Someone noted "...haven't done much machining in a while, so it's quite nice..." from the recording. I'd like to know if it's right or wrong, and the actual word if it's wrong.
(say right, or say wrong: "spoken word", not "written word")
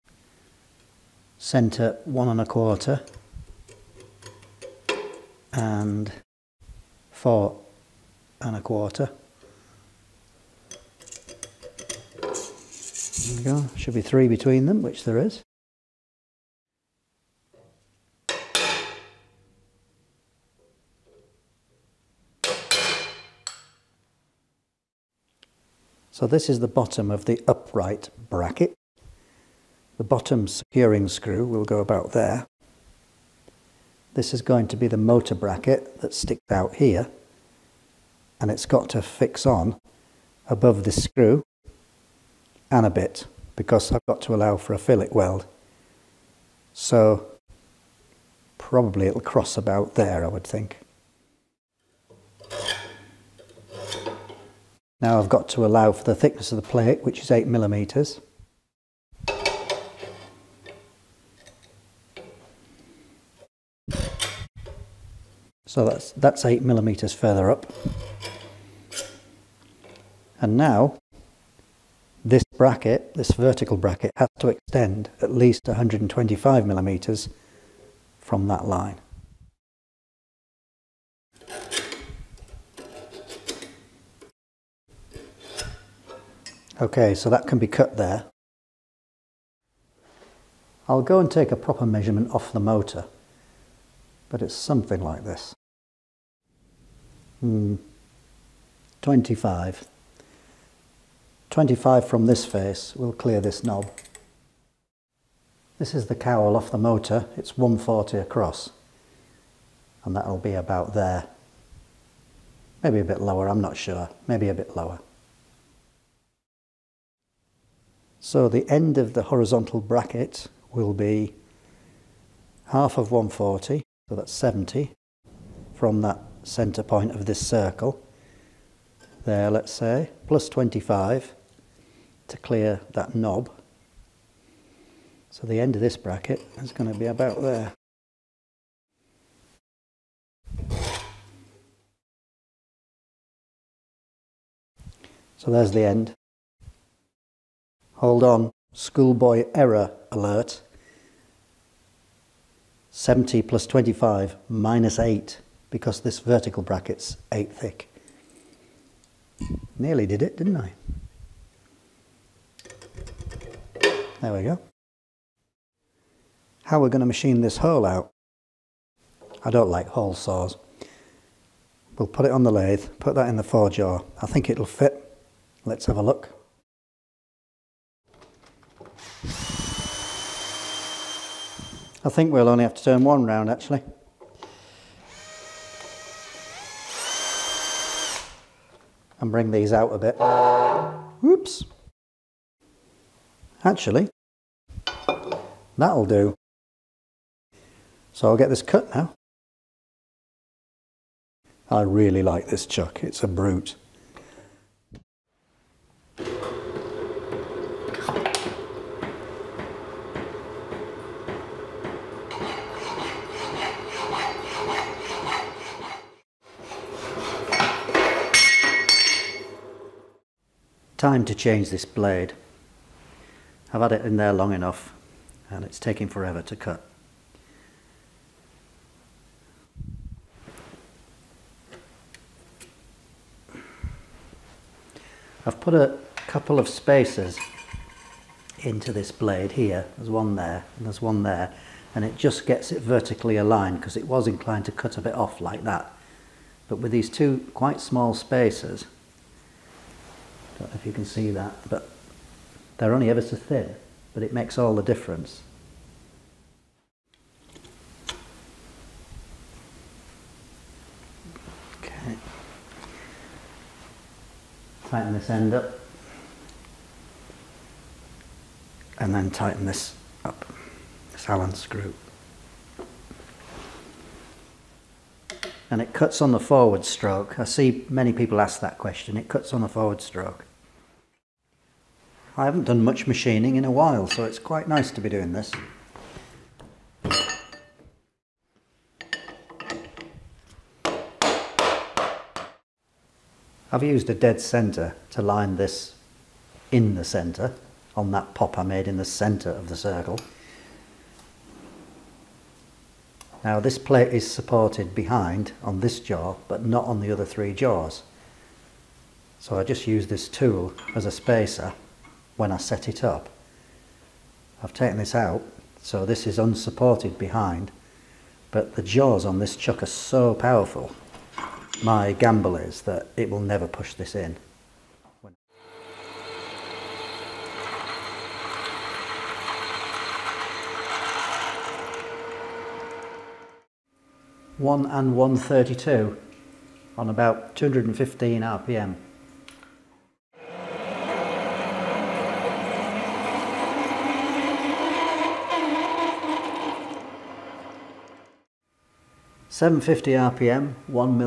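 right.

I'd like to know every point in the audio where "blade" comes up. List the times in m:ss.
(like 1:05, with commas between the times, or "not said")
3:41, 3:59.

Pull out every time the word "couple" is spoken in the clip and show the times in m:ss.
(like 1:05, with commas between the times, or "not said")
3:56.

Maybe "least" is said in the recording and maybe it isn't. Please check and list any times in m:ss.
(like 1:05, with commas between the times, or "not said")
1:15.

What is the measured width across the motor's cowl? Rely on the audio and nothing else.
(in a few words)
140.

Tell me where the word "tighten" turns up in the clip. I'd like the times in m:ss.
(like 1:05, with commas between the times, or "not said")
4:24, 4:29.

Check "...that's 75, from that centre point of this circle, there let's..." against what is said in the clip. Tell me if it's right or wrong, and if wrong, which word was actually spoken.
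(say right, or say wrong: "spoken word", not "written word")
wrong: "70", not "75".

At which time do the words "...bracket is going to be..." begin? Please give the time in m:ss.
2:15.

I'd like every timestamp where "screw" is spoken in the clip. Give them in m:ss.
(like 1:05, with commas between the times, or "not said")
0:31, 0:41, 4:31.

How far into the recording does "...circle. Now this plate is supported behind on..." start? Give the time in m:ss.
4:59.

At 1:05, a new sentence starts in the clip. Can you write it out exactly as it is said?
So that's, that's 8 millimetres further up.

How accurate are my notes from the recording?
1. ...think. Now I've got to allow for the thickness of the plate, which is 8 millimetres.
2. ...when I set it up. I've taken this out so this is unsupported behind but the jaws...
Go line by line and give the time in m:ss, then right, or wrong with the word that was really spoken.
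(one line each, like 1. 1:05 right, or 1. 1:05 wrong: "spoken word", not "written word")
1. 0:50 right
2. 5:12 right.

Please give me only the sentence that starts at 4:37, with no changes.
I see many people ask that question.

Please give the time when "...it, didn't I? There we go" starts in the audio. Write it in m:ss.
2:40.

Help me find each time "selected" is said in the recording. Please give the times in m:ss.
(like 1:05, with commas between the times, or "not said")
not said.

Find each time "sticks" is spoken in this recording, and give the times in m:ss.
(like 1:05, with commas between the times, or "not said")
0:36.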